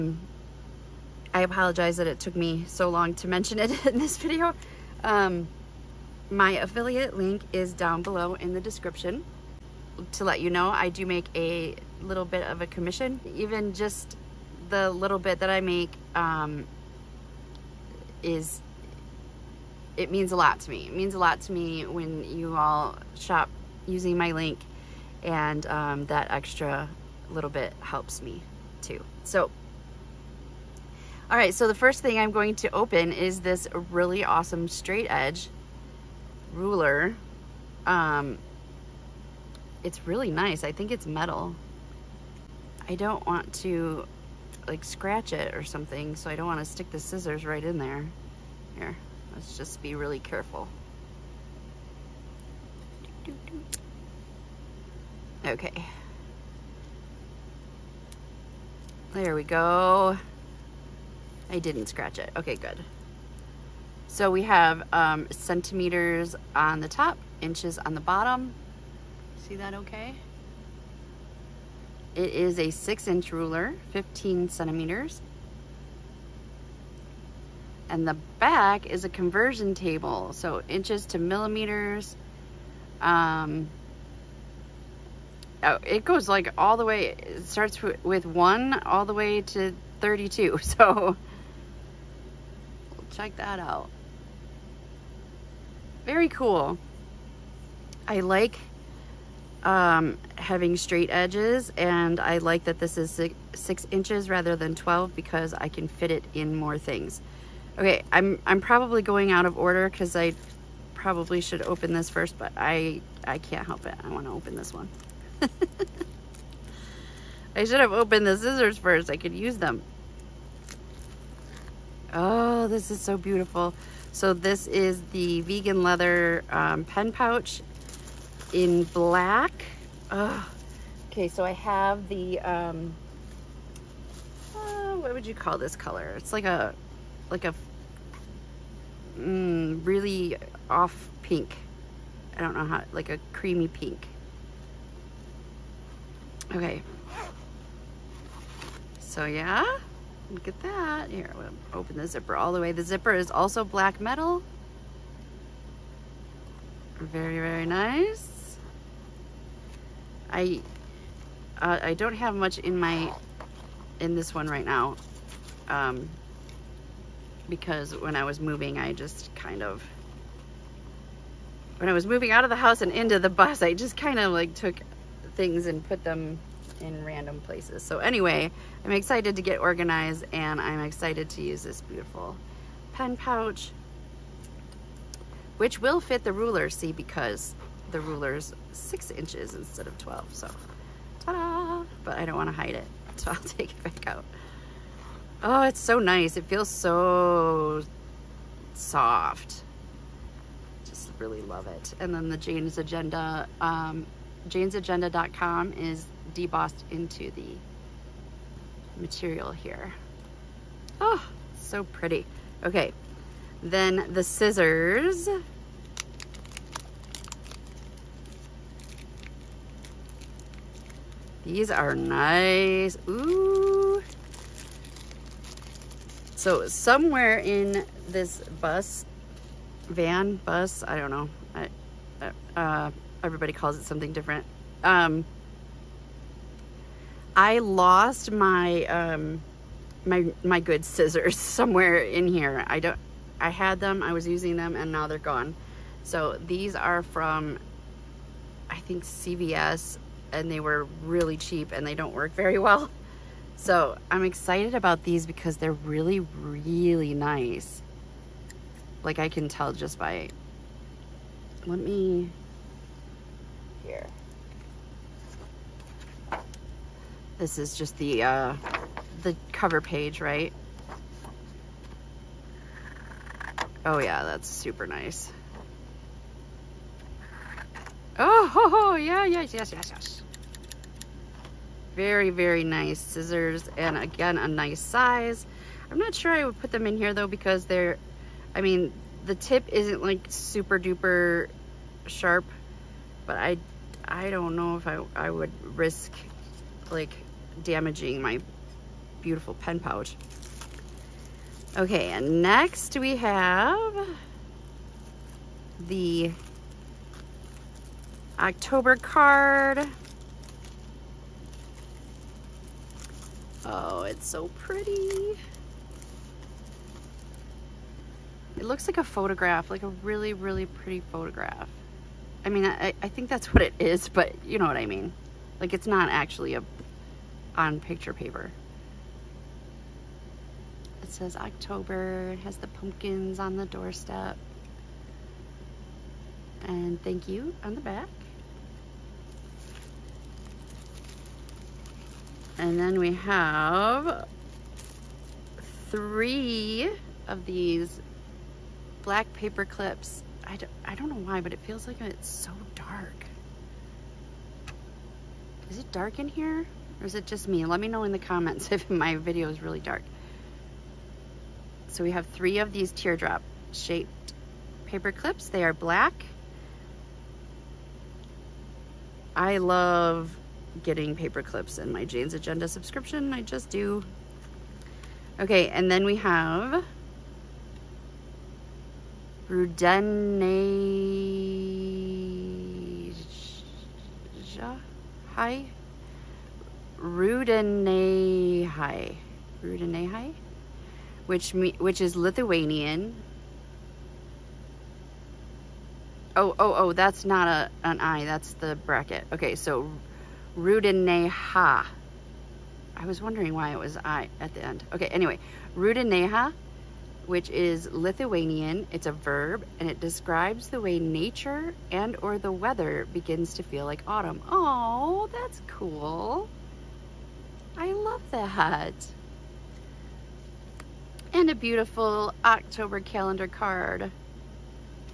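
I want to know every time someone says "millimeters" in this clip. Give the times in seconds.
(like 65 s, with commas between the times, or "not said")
81 s.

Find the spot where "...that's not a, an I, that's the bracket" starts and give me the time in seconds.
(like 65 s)
396 s.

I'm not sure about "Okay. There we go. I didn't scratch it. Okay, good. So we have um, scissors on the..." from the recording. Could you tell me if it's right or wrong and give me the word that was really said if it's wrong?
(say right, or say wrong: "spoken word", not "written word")
wrong: "centimeters", not "scissors".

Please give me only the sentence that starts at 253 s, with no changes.
So I'm excited about these because they're really, really nice.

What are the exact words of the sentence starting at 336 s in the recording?
And thank you on the back.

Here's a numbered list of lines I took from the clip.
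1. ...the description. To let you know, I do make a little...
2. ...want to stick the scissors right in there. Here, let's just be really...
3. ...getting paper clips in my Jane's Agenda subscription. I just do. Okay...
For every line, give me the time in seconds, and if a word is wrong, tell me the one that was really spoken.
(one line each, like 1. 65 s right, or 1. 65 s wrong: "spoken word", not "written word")
1. 8 s right
2. 46 s right
3. 370 s right.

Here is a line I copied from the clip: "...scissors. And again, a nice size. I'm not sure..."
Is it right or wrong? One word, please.
right.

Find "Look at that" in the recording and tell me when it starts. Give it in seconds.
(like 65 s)
150 s.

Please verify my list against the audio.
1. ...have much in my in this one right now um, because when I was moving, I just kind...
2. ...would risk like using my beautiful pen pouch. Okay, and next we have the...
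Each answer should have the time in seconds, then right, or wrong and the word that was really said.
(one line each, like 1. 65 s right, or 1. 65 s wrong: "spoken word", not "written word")
1. 162 s right
2. 295 s wrong: "damaging", not "using".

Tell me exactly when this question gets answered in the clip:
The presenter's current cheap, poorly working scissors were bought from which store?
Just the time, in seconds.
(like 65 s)
249 s.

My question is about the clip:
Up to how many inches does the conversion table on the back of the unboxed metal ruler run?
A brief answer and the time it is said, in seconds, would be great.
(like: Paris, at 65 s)
32, at 89 s.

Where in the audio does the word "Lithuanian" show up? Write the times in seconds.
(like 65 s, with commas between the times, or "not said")
392 s, 407 s.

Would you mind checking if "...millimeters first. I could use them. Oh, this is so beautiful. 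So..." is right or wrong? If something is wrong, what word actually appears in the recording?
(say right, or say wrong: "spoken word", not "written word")
wrong: "scissors", not "millimeters".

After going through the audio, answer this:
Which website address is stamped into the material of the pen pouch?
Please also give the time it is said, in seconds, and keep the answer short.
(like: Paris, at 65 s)
janesagenda.com, at 204 s.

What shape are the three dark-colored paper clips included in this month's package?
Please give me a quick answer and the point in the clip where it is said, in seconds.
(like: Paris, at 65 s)
teardrop, at 362 s.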